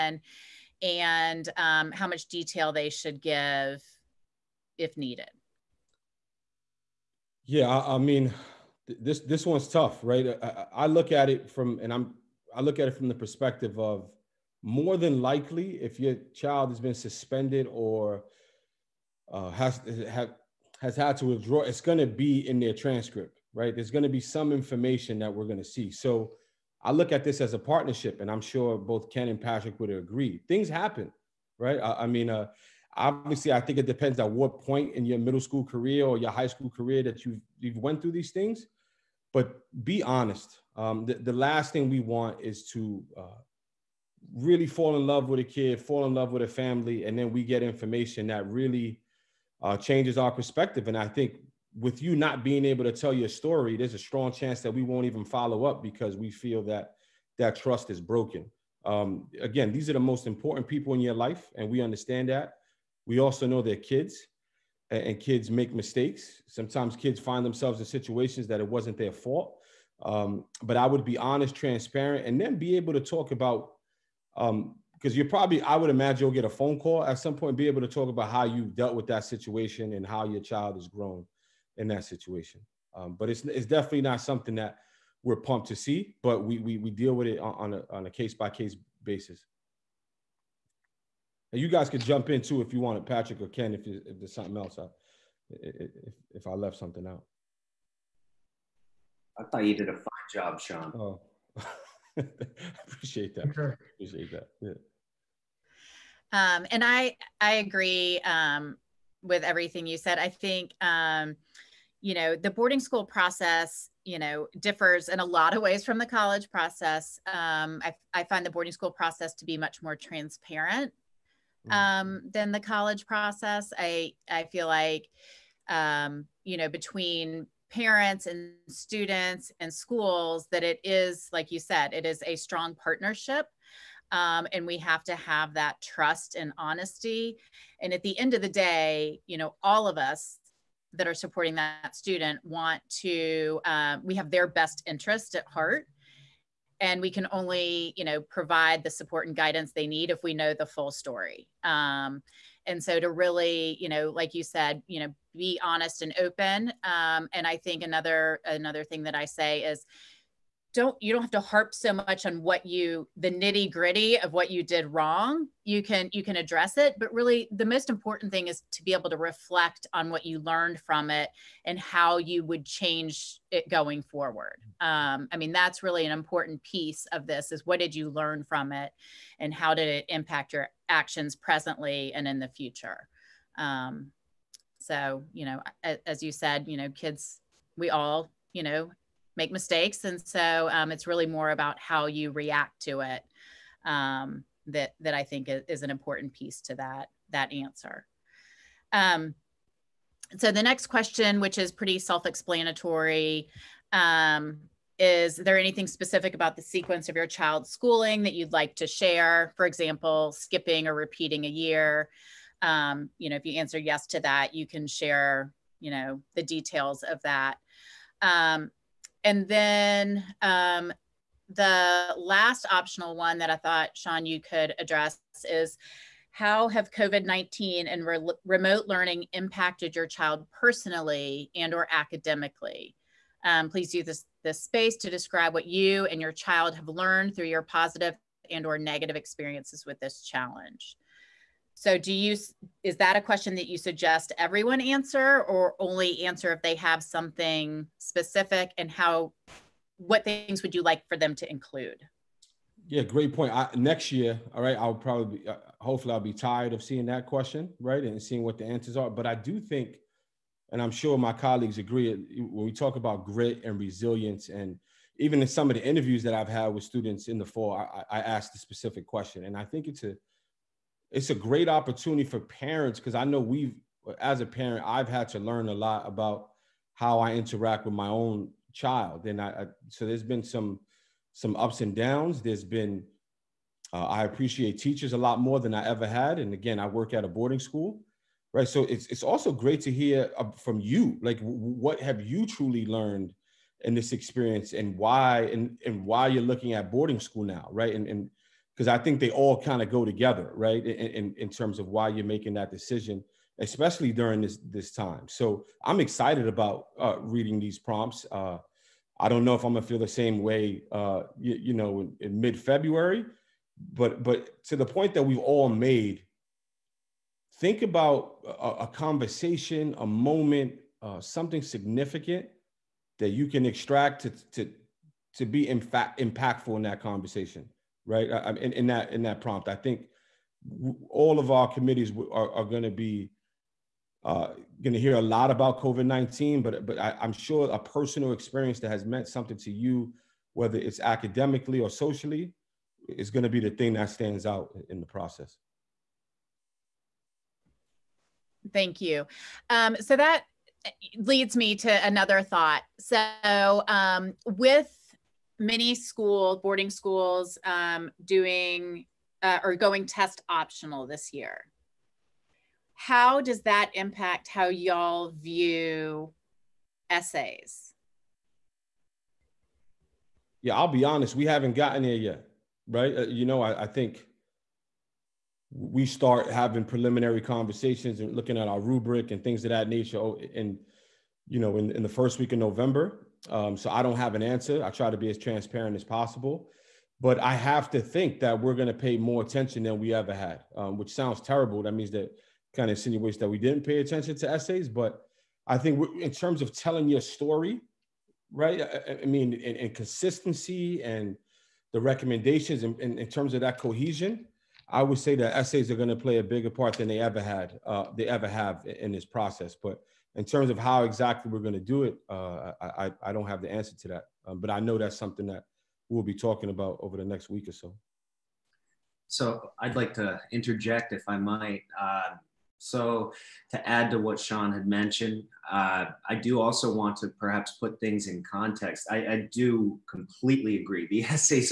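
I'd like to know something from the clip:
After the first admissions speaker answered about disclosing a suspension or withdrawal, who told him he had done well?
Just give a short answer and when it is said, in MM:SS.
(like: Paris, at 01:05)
Patrick or Ken, at 01:33.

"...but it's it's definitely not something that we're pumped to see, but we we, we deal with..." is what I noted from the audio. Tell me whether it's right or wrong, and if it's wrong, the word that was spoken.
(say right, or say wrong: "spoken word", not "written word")
right.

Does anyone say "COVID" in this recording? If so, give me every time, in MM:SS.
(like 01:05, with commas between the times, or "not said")
03:46, 05:35.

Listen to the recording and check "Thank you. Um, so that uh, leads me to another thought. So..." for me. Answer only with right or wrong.
right.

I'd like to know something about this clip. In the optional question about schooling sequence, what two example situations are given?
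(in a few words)
skipping or repeating a year.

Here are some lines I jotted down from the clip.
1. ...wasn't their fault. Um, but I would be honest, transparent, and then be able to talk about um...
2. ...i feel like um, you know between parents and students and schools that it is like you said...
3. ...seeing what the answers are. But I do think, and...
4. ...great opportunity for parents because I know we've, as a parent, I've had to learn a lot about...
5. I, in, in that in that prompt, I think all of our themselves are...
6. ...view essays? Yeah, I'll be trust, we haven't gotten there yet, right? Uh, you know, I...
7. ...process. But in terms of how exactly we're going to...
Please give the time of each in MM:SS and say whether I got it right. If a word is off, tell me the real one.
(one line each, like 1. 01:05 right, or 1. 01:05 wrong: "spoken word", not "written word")
1. 01:08 right
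2. 02:04 right
3. 04:18 right
4. 04:31 right
5. 05:28 wrong: "committees", not "themselves"
6. 06:05 wrong: "honest", not "trust"
7. 06:49 right.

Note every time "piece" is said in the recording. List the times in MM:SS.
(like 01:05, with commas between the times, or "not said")
02:56, 03:16.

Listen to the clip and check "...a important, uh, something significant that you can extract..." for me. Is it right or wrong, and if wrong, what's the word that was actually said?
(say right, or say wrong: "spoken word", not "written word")
wrong: "moment", not "important".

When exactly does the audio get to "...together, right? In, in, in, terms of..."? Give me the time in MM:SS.
05:00.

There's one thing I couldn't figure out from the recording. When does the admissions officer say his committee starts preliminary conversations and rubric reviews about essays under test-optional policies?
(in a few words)
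the first week of November.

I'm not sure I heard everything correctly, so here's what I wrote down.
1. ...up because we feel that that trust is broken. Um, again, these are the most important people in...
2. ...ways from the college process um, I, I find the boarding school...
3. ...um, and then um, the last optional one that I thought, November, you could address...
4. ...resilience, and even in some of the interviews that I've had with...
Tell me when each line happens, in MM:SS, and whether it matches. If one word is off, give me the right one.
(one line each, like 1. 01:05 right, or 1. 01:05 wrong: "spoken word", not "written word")
1. 00:55 right
2. 01:55 right
3. 03:38 wrong: "Sean", not "November"
4. 04:23 right.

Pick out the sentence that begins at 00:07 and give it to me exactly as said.
Yeah, I, I mean, th- this this one's tough, right?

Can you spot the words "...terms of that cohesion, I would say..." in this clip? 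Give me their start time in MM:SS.
06:43.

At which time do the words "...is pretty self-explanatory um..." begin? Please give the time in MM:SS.
03:21.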